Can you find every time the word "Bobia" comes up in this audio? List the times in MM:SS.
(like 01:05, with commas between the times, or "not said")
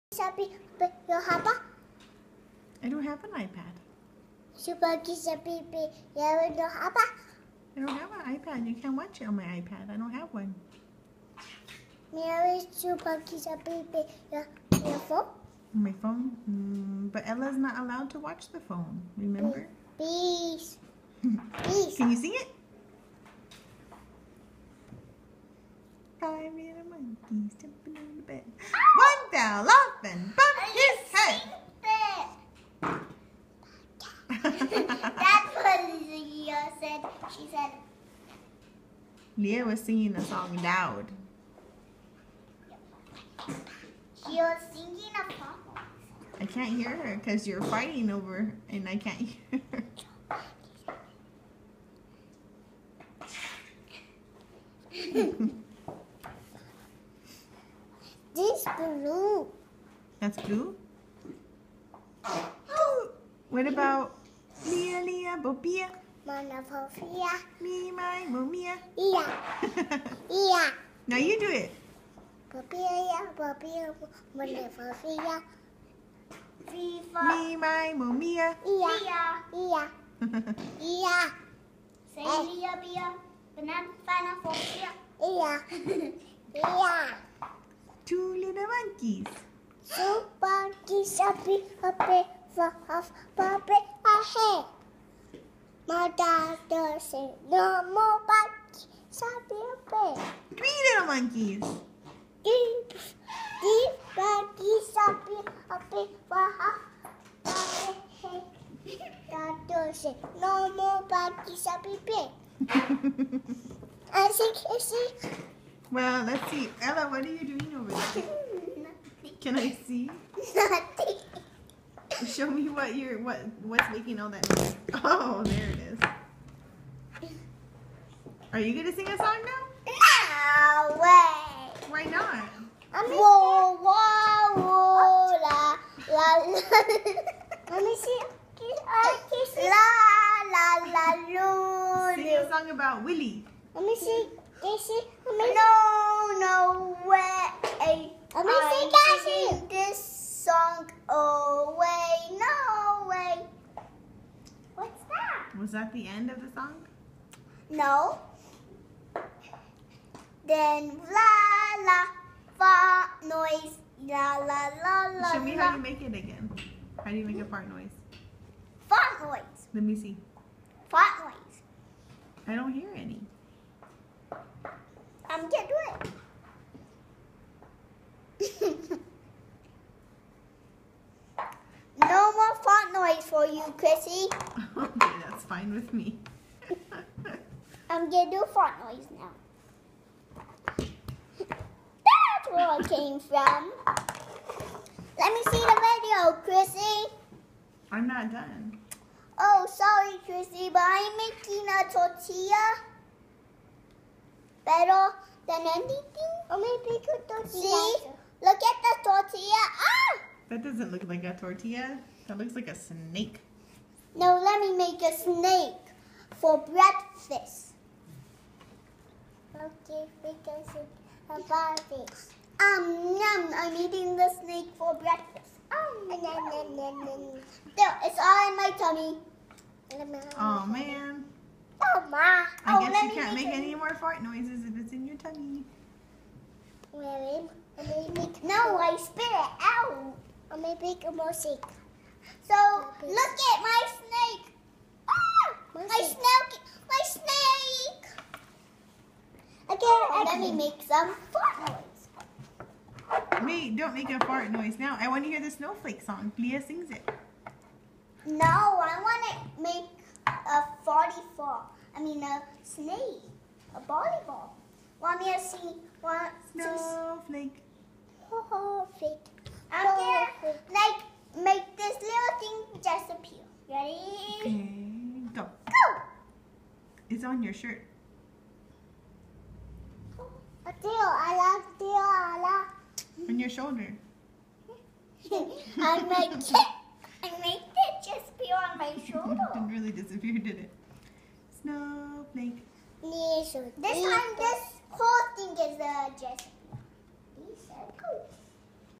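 01:05.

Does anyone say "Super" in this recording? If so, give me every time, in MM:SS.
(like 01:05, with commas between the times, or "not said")
00:04, 00:12.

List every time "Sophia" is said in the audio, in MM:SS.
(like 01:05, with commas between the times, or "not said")
01:06, 01:14, 01:24.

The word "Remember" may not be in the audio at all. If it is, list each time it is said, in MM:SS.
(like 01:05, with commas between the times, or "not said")
00:19.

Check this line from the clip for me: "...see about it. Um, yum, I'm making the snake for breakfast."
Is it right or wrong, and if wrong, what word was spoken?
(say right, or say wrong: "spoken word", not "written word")
wrong: "eating", not "making".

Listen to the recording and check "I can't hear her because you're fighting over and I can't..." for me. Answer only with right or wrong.
right.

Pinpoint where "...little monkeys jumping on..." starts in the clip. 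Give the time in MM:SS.
00:26.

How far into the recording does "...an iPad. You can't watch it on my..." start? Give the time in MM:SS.
00:08.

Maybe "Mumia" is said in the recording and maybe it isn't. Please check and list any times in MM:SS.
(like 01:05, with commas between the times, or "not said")
01:08, 01:17.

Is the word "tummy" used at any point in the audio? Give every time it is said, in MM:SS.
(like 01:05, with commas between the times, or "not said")
03:48, 03:55.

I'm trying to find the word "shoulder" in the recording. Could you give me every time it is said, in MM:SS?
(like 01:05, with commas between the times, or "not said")
04:43, 04:49.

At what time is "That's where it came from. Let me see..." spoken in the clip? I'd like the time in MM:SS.
03:10.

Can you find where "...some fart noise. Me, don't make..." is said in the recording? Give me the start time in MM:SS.
04:10.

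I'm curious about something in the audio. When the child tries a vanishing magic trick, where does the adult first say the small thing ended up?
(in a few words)
On your shirt.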